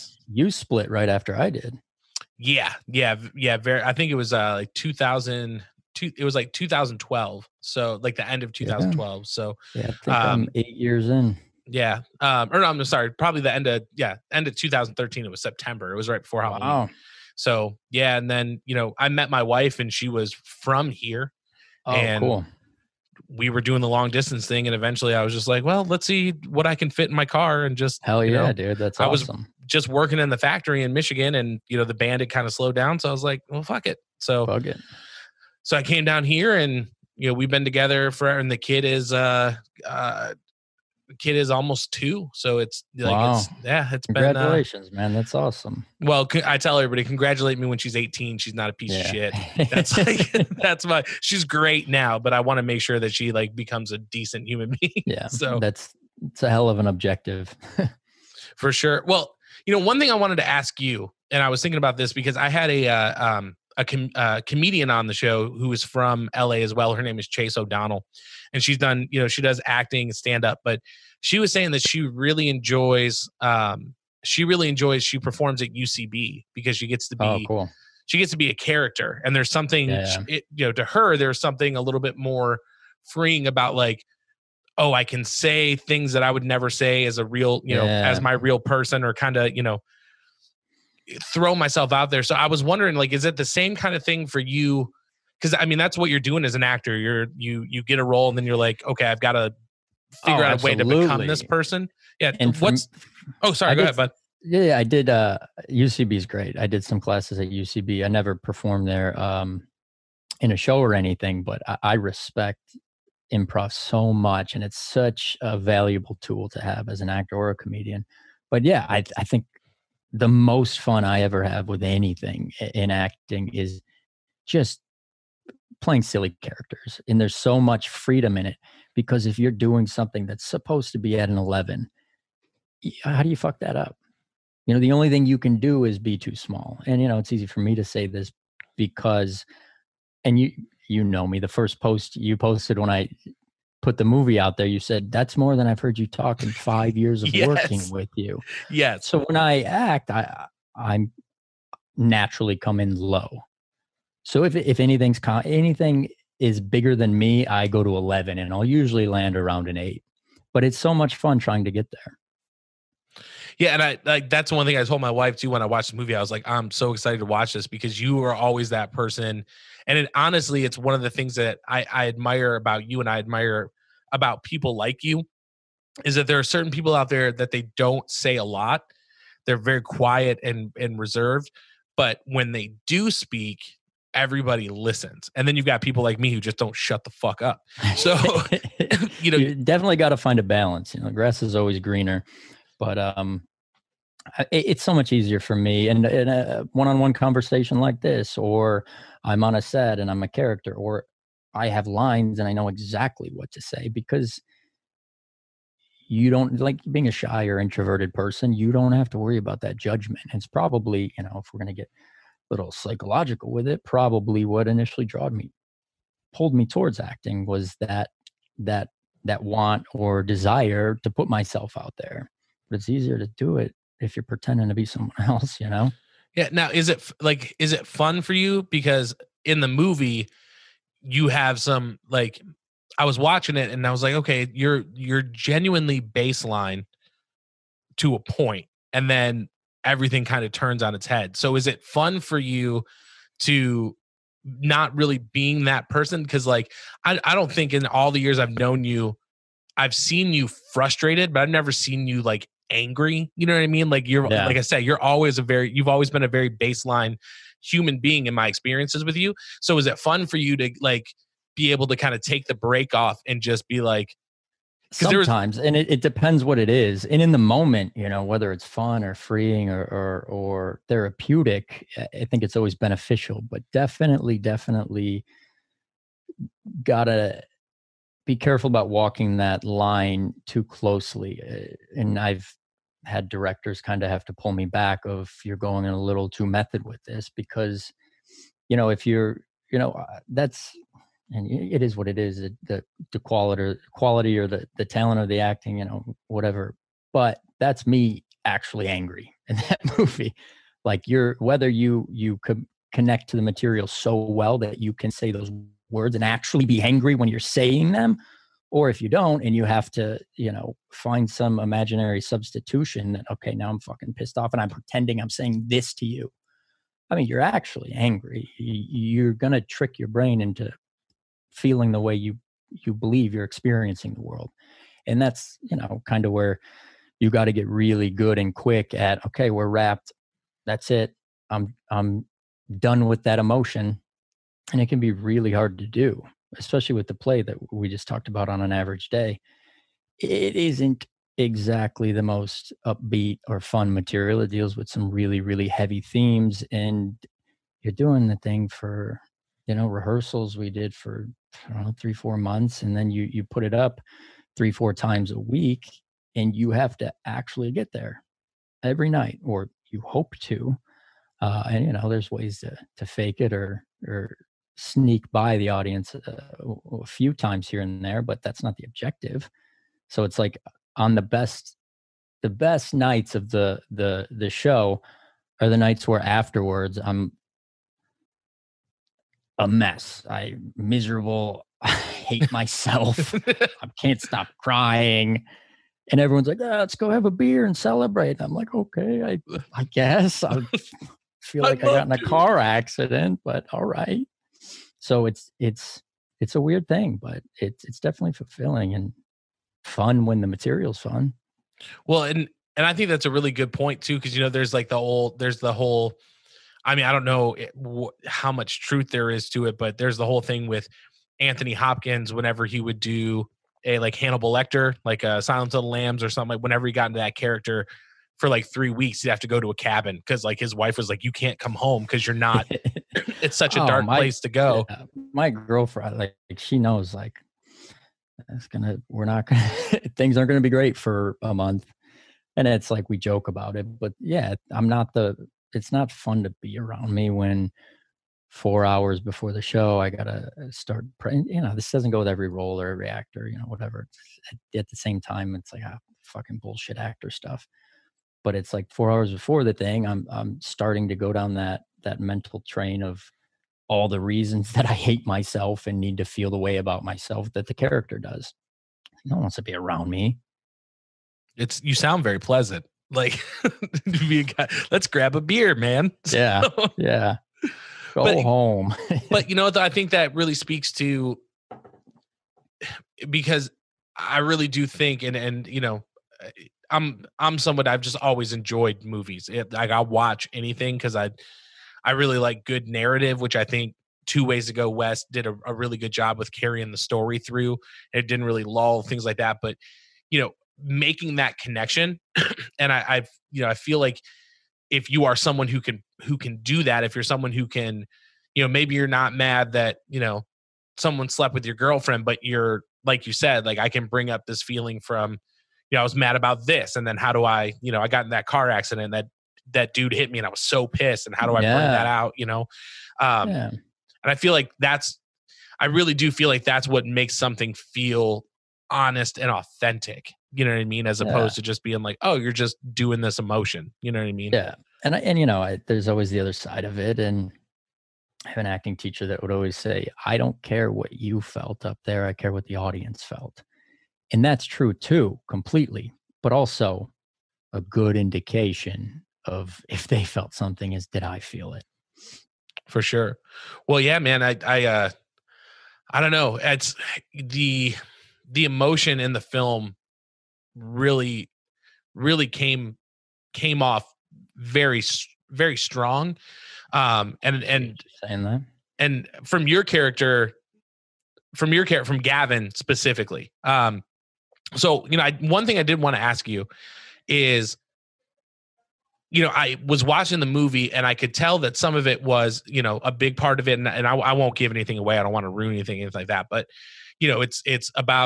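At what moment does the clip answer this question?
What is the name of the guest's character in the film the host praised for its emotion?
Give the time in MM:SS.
09:22.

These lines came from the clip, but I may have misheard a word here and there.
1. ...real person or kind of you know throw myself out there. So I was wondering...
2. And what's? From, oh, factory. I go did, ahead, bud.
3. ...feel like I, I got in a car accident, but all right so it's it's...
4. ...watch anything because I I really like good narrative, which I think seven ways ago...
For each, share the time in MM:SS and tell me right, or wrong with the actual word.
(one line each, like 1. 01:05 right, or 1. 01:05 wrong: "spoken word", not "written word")
1. 01:28 right
2. 01:42 wrong: "sorry", not "factory"
3. 06:31 right
4. 07:59 wrong: "two", not "seven".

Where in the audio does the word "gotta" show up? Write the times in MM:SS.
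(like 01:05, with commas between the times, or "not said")
04:36, 07:20.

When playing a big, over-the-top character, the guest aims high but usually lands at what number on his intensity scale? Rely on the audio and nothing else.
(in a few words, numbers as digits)
8.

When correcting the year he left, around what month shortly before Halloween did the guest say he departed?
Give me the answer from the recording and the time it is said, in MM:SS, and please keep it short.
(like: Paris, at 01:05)
September, at 00:15.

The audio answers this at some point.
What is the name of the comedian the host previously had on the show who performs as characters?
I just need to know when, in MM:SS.
01:07.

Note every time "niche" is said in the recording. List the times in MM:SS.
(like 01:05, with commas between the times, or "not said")
not said.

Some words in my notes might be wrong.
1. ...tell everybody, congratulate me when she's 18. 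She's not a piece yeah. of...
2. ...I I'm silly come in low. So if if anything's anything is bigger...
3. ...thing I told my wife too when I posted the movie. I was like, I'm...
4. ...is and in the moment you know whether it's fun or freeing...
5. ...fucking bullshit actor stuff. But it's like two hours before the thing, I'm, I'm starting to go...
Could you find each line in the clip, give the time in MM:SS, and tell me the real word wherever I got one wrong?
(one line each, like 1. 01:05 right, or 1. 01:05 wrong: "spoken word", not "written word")
1. 00:46 right
2. 02:30 wrong: "naturally", not "silly"
3. 02:44 wrong: "watched", not "posted"
4. 04:26 right
5. 07:26 wrong: "four", not "two".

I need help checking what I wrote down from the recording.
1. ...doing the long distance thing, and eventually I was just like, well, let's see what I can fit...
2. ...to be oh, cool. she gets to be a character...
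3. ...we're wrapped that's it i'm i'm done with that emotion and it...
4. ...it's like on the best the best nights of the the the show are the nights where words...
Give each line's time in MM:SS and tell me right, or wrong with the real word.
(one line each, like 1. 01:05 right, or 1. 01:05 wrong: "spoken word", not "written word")
1. 00:23 right
2. 01:17 right
3. 05:29 right
4. 06:10 wrong: "afterwards", not "words".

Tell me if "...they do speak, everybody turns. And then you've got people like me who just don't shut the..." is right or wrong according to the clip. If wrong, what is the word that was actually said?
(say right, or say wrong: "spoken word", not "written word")
wrong: "listens", not "turns".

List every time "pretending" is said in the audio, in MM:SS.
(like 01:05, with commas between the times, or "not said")
03:44, 05:14.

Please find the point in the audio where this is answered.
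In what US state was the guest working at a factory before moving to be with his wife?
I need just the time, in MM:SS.
00:30.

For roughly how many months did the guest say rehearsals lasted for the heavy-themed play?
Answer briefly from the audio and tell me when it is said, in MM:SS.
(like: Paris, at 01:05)
3 to 4 months, at 05:51.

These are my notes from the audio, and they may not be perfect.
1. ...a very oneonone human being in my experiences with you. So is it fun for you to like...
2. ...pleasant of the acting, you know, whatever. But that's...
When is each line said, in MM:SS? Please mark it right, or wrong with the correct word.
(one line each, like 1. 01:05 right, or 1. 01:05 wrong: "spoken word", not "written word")
1. 04:16 wrong: "baseline", not "oneonone"
2. 04:54 wrong: "talent", not "pleasant".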